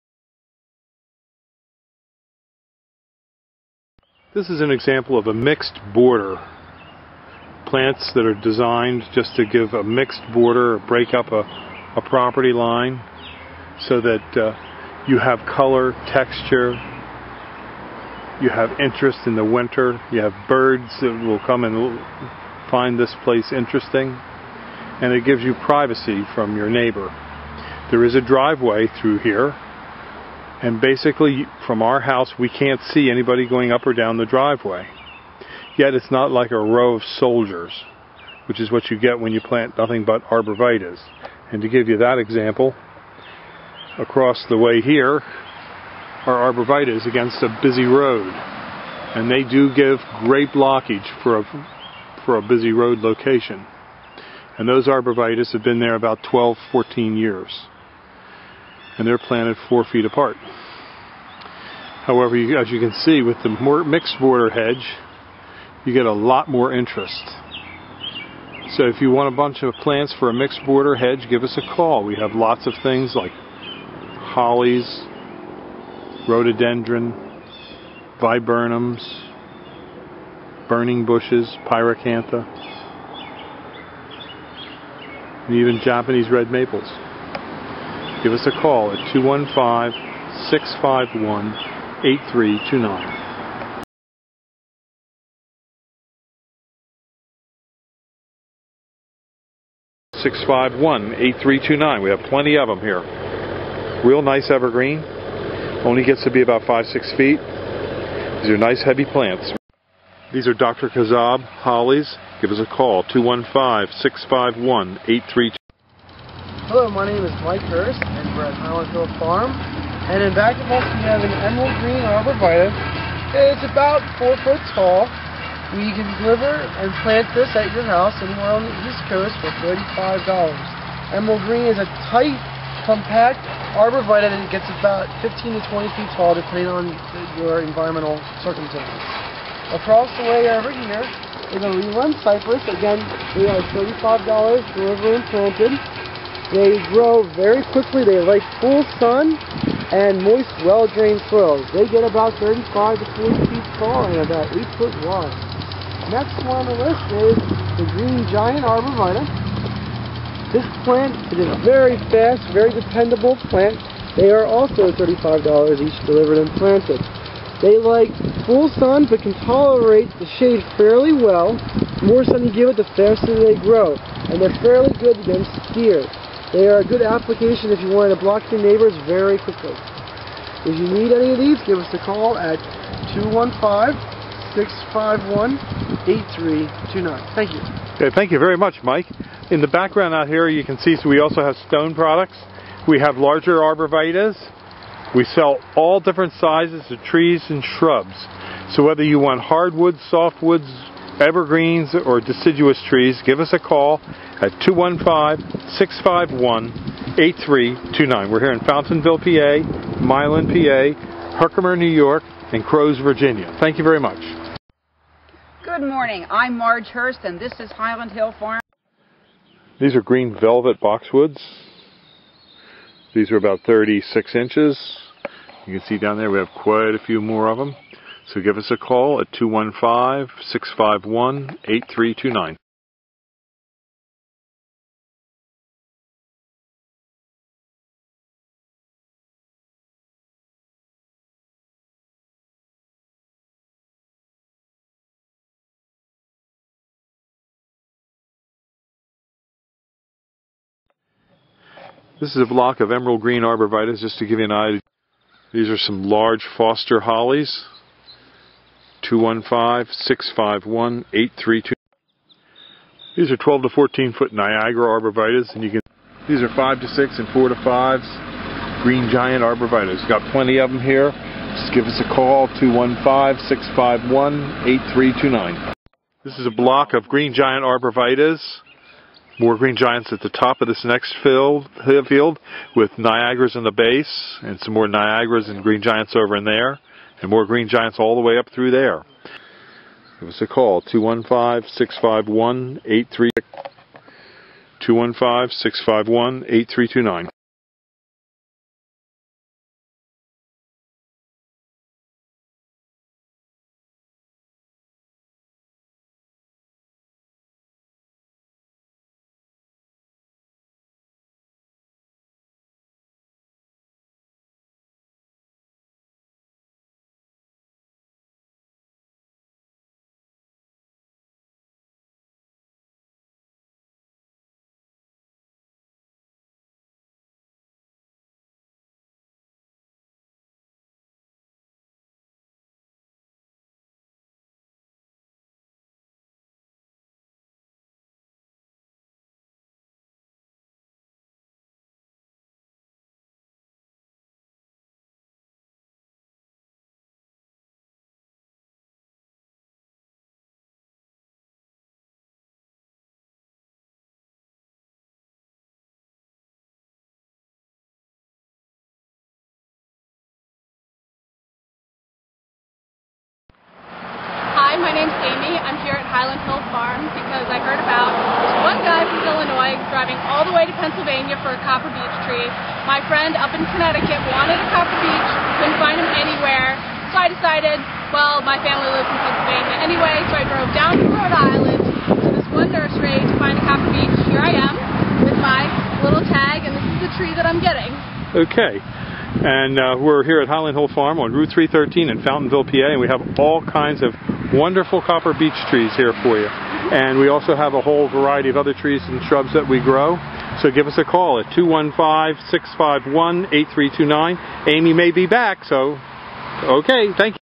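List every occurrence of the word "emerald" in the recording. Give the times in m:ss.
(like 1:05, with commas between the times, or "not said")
2:01, 2:11, 4:12.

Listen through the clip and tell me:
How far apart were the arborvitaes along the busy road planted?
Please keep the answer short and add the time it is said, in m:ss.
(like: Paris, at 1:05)
4 feet, at 0:59.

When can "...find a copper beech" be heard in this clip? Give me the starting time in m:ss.
6:23.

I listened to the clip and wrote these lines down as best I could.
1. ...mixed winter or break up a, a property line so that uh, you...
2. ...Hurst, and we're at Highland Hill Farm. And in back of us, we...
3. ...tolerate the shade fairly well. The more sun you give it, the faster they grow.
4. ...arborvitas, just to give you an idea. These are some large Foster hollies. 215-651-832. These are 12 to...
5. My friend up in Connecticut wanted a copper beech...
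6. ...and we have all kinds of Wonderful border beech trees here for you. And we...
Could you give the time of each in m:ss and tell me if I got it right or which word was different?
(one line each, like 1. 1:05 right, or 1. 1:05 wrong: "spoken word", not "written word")
1. 0:09 wrong: "border", not "winter"
2. 1:57 right
3. 2:49 right
4. 4:13 right
5. 6:12 right
6. 6:32 wrong: "copper", not "border".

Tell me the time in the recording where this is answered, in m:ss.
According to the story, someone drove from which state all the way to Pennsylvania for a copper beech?
6:09.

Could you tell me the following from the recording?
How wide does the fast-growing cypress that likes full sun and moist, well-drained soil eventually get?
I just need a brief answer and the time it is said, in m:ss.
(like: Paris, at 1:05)
8 feet, at 2:34.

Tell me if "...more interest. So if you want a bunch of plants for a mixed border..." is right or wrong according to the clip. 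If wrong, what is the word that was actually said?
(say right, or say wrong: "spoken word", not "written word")
right.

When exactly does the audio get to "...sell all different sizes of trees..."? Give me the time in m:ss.
3:15.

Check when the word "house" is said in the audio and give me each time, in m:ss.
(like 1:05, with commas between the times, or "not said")
0:31, 2:07.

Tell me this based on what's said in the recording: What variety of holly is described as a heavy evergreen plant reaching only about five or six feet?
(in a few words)
Dr. Kassab.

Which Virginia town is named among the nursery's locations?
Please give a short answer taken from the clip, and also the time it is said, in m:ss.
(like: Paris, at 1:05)
Crows, at 3:32.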